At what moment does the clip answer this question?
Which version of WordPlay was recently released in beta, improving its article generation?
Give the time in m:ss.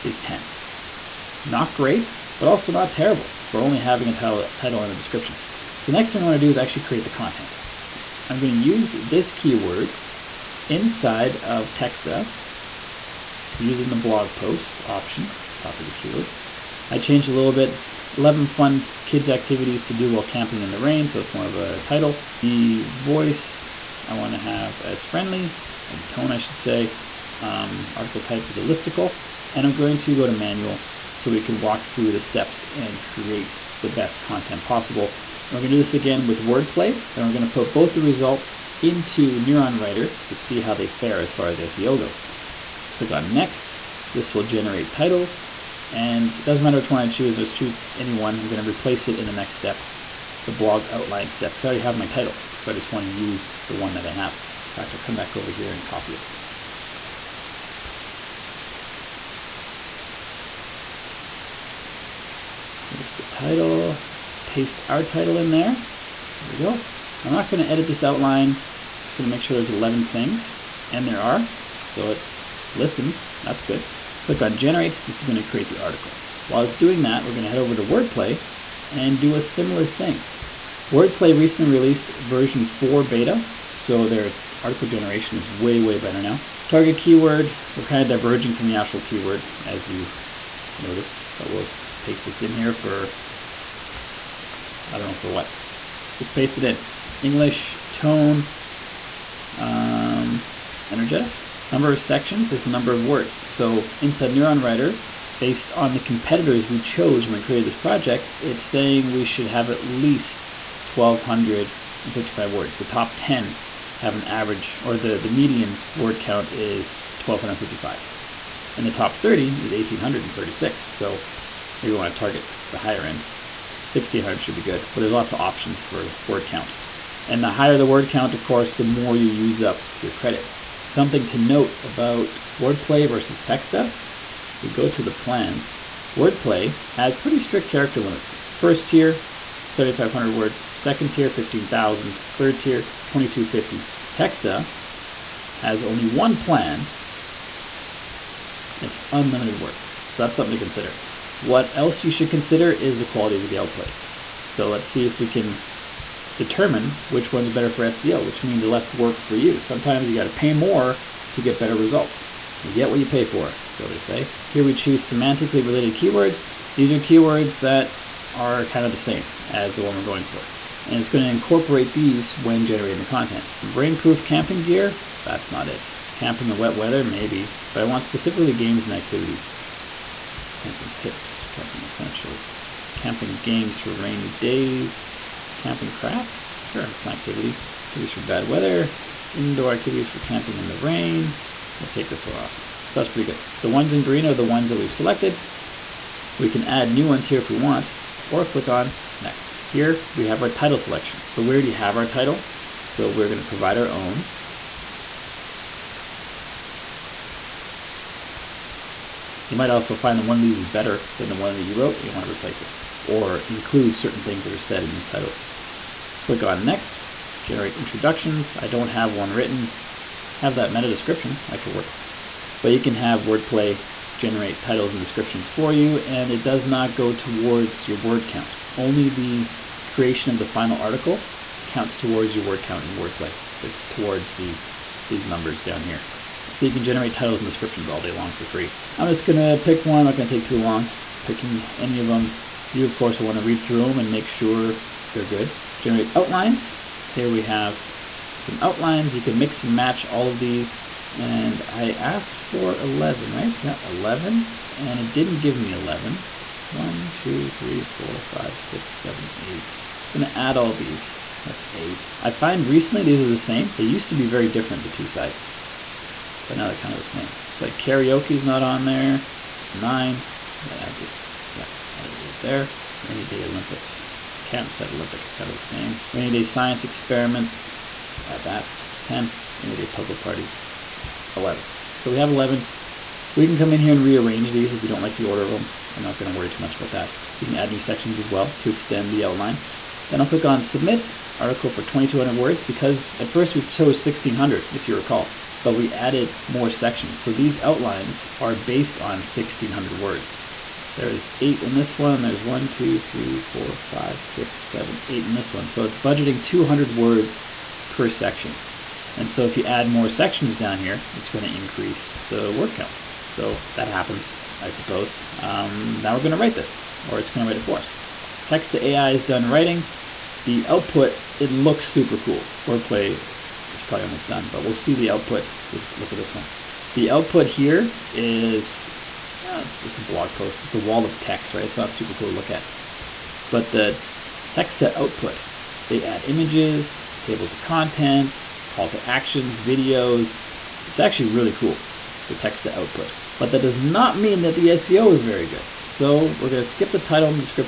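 1:22.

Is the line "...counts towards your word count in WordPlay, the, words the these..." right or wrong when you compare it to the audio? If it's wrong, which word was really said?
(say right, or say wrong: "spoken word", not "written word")
wrong: "towards", not "words".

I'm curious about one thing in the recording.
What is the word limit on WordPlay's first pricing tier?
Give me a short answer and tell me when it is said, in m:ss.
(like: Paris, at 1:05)
7,500 words, at 2:19.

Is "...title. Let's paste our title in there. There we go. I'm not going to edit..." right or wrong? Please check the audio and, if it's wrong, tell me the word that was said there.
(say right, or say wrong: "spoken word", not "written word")
right.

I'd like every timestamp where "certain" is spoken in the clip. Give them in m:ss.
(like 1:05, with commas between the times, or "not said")
3:33.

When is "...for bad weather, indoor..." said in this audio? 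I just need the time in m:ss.
3:08.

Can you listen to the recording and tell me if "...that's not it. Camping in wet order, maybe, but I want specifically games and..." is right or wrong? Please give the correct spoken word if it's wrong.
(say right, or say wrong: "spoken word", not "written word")
wrong: "weather", not "order".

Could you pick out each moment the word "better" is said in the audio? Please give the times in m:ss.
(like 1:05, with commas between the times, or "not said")
1:25, 2:37, 2:41, 3:30.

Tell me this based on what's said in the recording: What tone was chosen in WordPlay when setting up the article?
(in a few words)
Energetic.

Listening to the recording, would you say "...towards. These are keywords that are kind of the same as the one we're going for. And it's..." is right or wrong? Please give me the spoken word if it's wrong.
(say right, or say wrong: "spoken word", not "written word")
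wrong: "keywords", not "towards".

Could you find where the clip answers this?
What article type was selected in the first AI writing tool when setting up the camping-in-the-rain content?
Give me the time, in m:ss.
0:28.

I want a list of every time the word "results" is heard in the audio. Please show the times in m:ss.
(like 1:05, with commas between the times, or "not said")
0:38, 2:41.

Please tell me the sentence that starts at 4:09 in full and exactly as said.
You can mix and match all of these.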